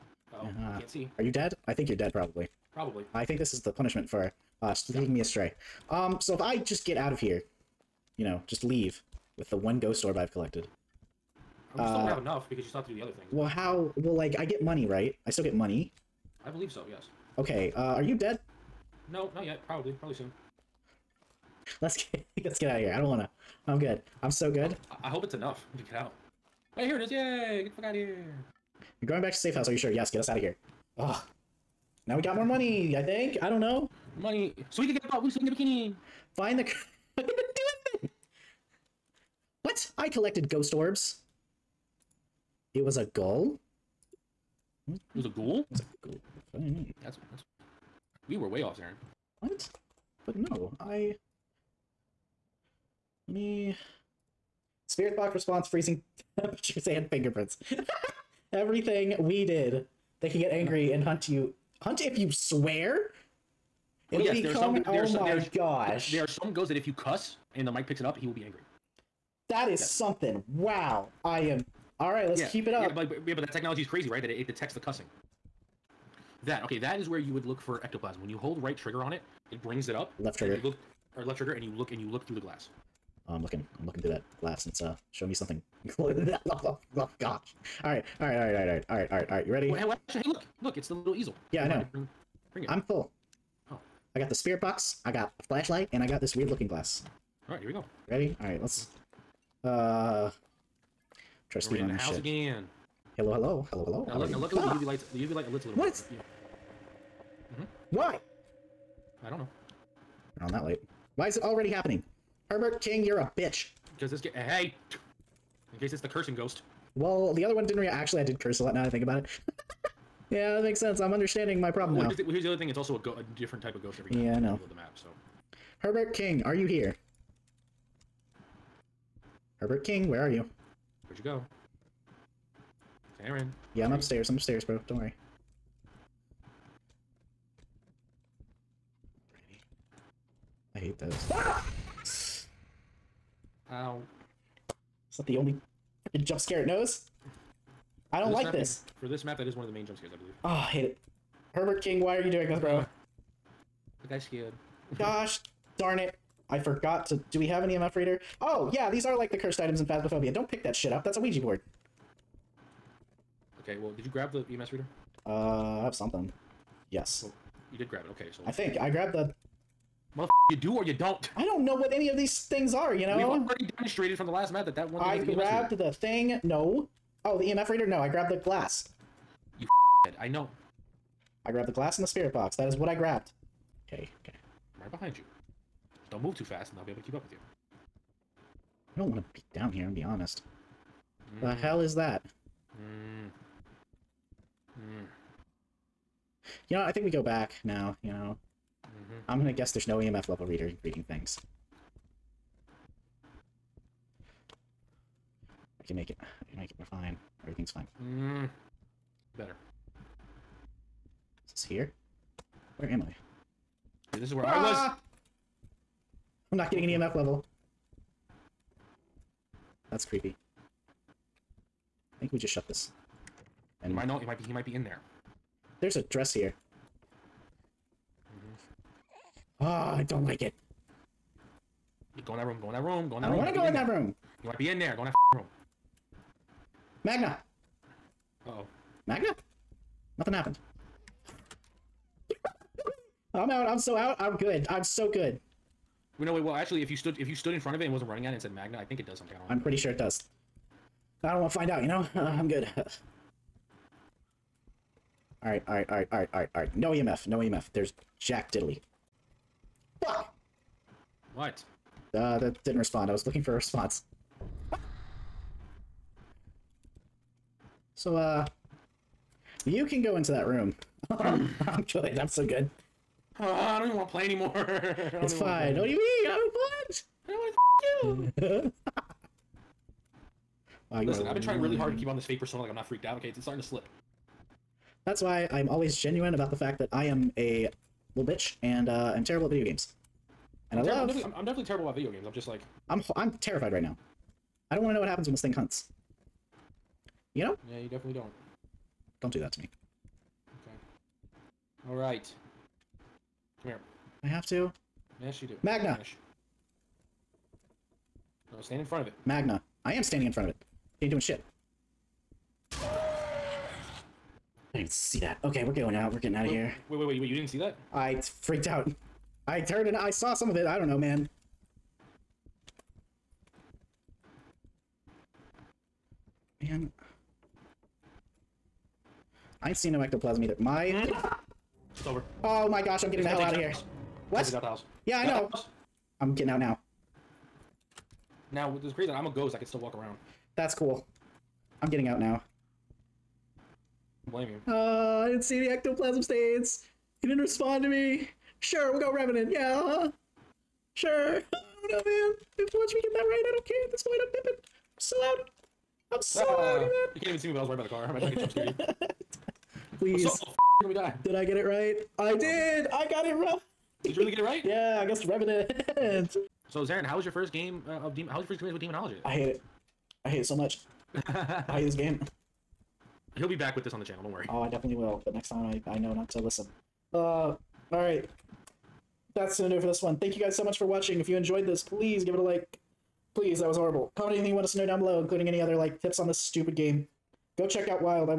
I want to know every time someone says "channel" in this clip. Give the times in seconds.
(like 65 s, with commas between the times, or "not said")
374 s.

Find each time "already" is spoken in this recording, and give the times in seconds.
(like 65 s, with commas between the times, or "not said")
111 s, 173 s.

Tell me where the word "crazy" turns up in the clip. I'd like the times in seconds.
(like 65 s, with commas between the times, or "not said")
73 s, 338 s.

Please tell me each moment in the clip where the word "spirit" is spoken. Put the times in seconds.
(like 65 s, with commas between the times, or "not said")
54 s, 94 s, 182 s.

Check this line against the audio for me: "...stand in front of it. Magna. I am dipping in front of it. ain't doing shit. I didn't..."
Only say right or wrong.
wrong.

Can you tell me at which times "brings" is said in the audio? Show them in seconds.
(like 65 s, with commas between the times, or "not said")
79 s, 92 s.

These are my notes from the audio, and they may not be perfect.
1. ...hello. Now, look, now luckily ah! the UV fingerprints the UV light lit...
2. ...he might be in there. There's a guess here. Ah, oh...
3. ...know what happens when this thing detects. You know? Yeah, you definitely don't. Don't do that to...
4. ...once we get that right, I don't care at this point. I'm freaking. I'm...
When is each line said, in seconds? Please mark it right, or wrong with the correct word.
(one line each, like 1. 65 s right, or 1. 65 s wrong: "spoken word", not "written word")
1. 103 s wrong: "lights", not "fingerprints"
2. 224 s wrong: "dress", not "guess"
3. 294 s wrong: "hunts", not "detects"
4. 352 s wrong: "dipping", not "freaking".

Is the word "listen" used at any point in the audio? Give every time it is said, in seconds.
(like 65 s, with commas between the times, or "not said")
281 s, 376 s.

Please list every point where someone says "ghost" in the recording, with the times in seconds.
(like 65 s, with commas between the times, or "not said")
9 s, 40 s, 66 s, 116 s, 123 s, 339 s.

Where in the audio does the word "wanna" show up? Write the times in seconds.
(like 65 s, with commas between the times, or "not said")
23 s.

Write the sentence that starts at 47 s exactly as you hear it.
That's, that's we were way off, Aaron.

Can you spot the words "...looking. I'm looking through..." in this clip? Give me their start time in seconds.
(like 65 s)
83 s.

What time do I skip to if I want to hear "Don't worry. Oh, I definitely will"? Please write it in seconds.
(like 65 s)
374 s.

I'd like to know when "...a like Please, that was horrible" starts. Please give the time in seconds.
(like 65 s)
382 s.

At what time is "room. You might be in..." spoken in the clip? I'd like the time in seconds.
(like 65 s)
233 s.